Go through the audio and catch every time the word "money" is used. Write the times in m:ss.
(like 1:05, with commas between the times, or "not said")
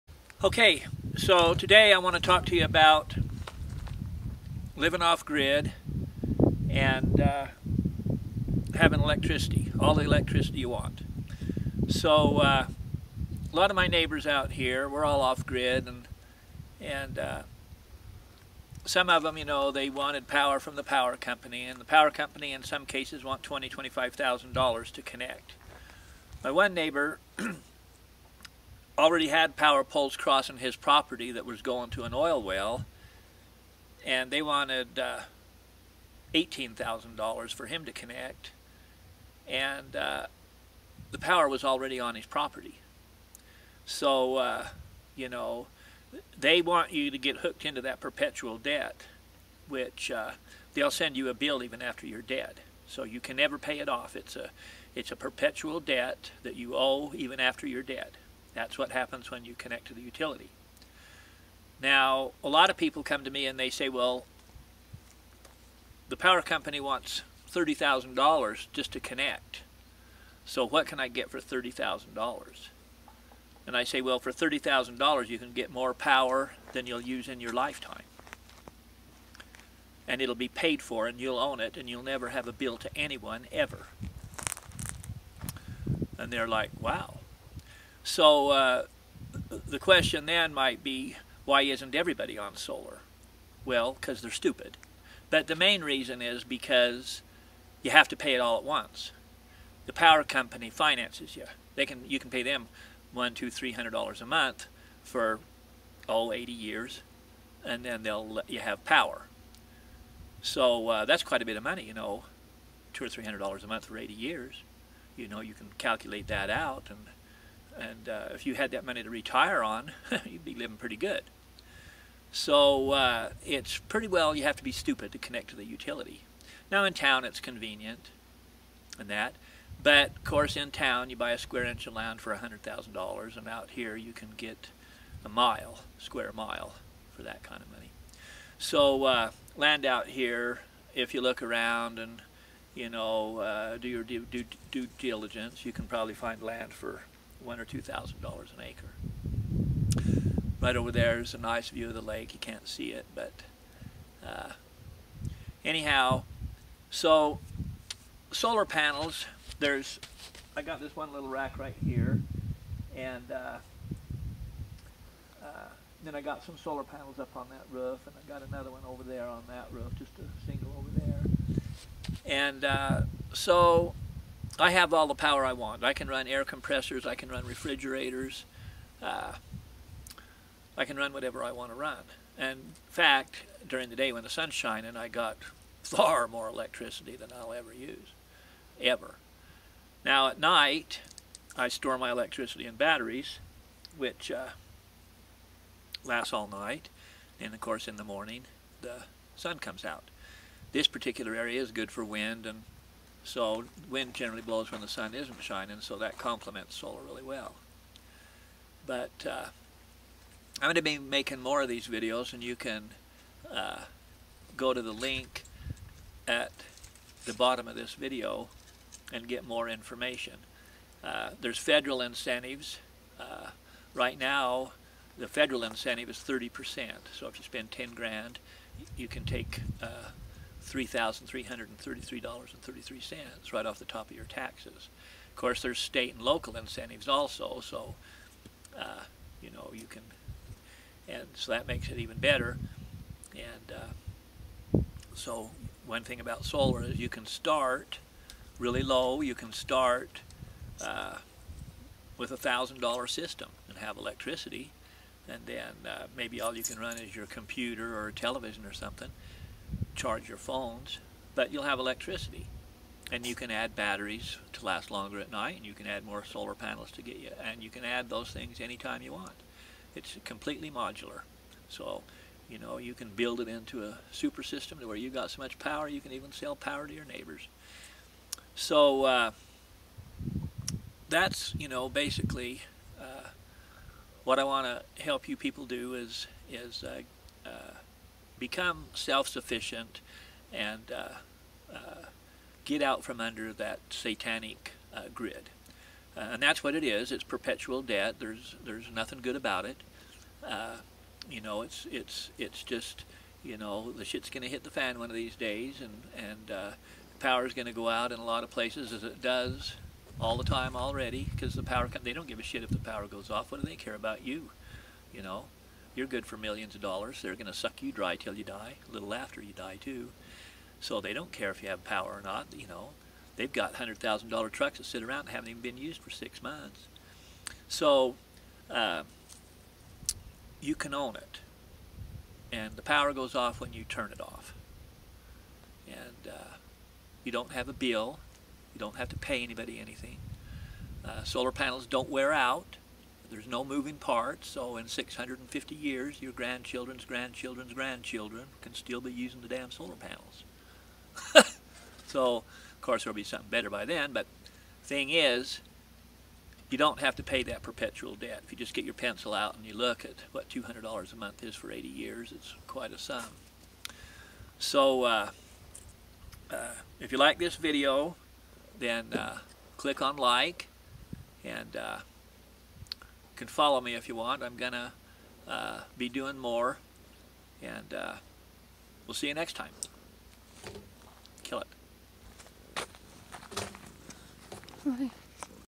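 1:51, 1:58, 2:17.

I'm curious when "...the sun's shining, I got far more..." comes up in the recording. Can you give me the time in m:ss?
3:04.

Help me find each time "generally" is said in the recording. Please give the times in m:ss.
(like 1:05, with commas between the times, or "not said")
3:24.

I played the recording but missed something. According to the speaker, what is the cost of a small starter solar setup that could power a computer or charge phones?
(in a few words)
$1,000.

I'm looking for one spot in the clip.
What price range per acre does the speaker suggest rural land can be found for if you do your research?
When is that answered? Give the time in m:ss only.
2:27.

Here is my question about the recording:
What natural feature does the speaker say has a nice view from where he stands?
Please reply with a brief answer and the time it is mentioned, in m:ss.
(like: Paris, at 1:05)
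The lake, at 2:31.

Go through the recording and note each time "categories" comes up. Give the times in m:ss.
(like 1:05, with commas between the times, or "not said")
not said.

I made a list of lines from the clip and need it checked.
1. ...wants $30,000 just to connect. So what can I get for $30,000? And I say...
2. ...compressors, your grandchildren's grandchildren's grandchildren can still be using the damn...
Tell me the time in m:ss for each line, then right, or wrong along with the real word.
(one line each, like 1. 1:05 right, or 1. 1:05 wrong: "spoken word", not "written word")
1. 1:06 right
2. 5:45 wrong: "years", not "compressors".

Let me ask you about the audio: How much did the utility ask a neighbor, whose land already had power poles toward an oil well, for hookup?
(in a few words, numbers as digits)
$18,000.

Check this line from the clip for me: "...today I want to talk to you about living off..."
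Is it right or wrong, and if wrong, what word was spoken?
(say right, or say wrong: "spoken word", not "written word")
right.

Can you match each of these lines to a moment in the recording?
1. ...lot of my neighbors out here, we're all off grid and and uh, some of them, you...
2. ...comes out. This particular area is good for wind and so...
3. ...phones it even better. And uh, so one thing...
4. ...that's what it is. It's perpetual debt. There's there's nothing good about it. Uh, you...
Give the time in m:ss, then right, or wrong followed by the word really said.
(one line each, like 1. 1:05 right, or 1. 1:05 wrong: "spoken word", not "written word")
1. 0:13 right
2. 3:19 right
3. 4:01 wrong: "makes", not "phones"
4. 4:56 right.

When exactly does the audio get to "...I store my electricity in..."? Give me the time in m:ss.
3:11.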